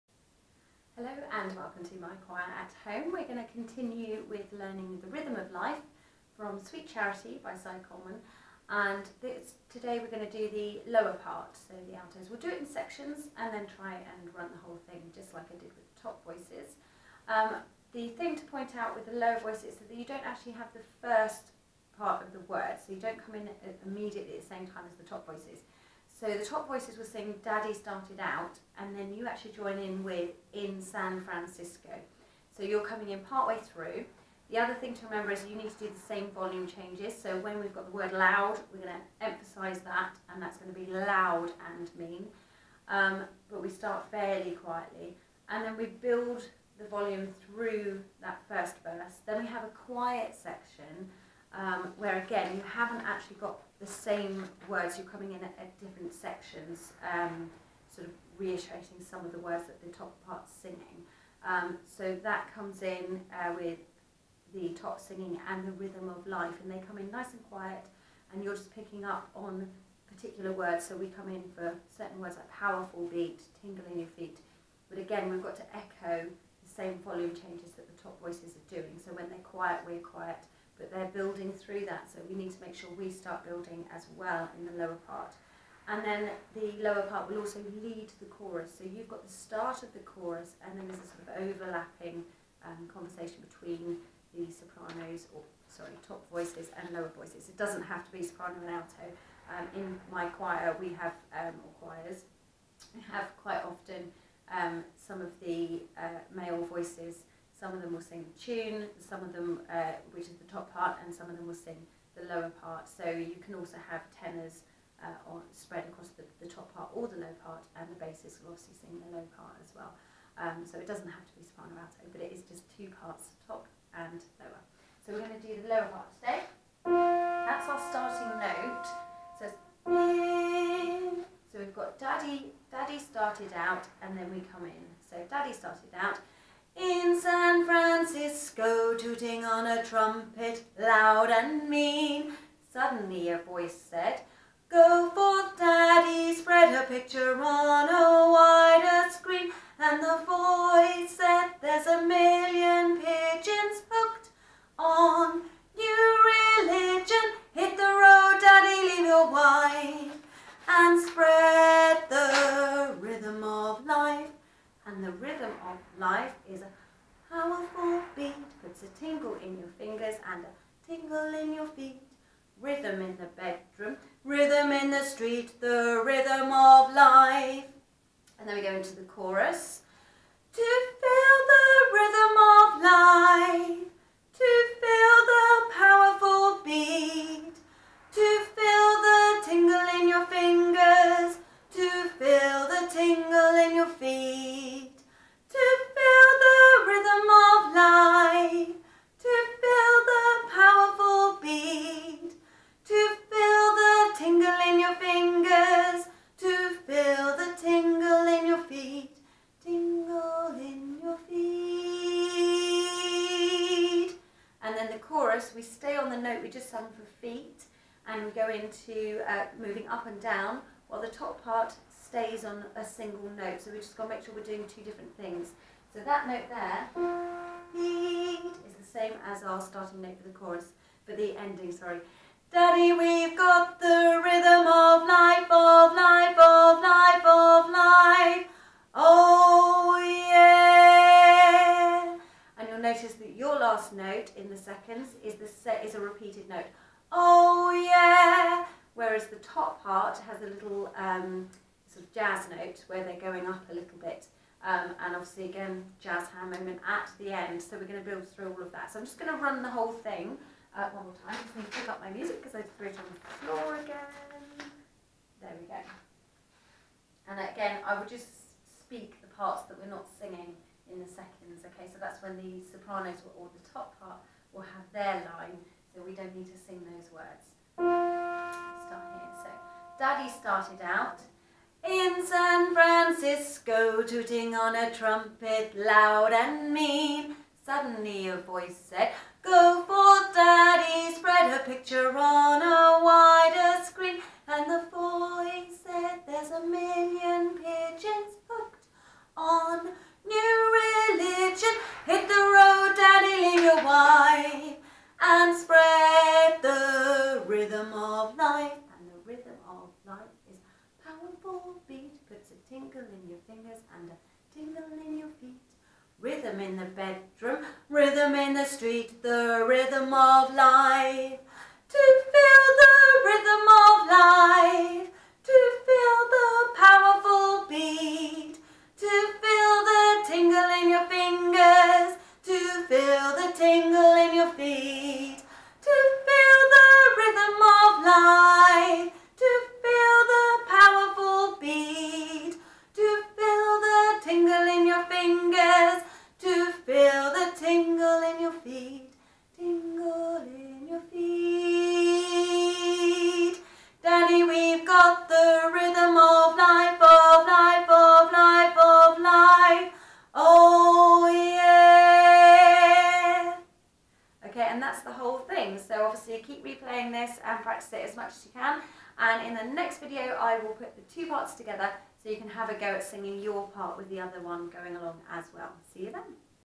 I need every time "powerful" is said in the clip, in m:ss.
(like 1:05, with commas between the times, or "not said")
1:12, 2:47, 3:05.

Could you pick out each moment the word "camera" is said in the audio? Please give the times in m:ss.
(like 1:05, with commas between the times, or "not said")
not said.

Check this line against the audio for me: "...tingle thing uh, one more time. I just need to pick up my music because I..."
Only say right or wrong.
wrong.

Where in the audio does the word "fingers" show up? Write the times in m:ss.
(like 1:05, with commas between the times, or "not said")
2:49, 5:13.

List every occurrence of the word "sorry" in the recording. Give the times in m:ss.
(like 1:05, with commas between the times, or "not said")
1:35, 3:51.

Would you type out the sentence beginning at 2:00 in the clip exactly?
Um, so it doesn't have to be soprano alto, but it is just two parts, top and lower.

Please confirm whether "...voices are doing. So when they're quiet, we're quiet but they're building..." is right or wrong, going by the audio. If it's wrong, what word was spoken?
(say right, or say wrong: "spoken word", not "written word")
right.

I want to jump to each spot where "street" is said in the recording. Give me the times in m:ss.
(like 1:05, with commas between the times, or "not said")
2:55, 5:18.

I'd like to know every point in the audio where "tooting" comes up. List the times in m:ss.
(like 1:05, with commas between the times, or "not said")
2:18, 4:44.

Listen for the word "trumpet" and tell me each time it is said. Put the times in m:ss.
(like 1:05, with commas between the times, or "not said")
2:19, 4:44.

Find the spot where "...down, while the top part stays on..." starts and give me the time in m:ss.
3:40.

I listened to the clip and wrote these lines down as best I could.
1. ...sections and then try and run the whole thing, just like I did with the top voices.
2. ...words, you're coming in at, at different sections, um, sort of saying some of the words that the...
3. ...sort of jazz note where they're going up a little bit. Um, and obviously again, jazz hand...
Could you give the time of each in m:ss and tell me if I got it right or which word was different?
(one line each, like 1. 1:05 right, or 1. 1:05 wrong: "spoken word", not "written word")
1. 0:12 right
2. 0:54 wrong: "reiterating", not "saying"
3. 4:11 right.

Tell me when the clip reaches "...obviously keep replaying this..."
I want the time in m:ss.
6:06.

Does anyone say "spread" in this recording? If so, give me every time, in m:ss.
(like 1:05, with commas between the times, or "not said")
1:55, 4:51.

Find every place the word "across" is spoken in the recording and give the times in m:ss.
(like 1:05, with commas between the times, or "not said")
1:55.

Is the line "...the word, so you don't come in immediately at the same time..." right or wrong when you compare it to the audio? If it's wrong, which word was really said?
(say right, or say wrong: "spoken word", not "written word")
right.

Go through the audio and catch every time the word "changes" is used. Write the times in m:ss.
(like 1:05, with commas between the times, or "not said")
0:36, 1:17.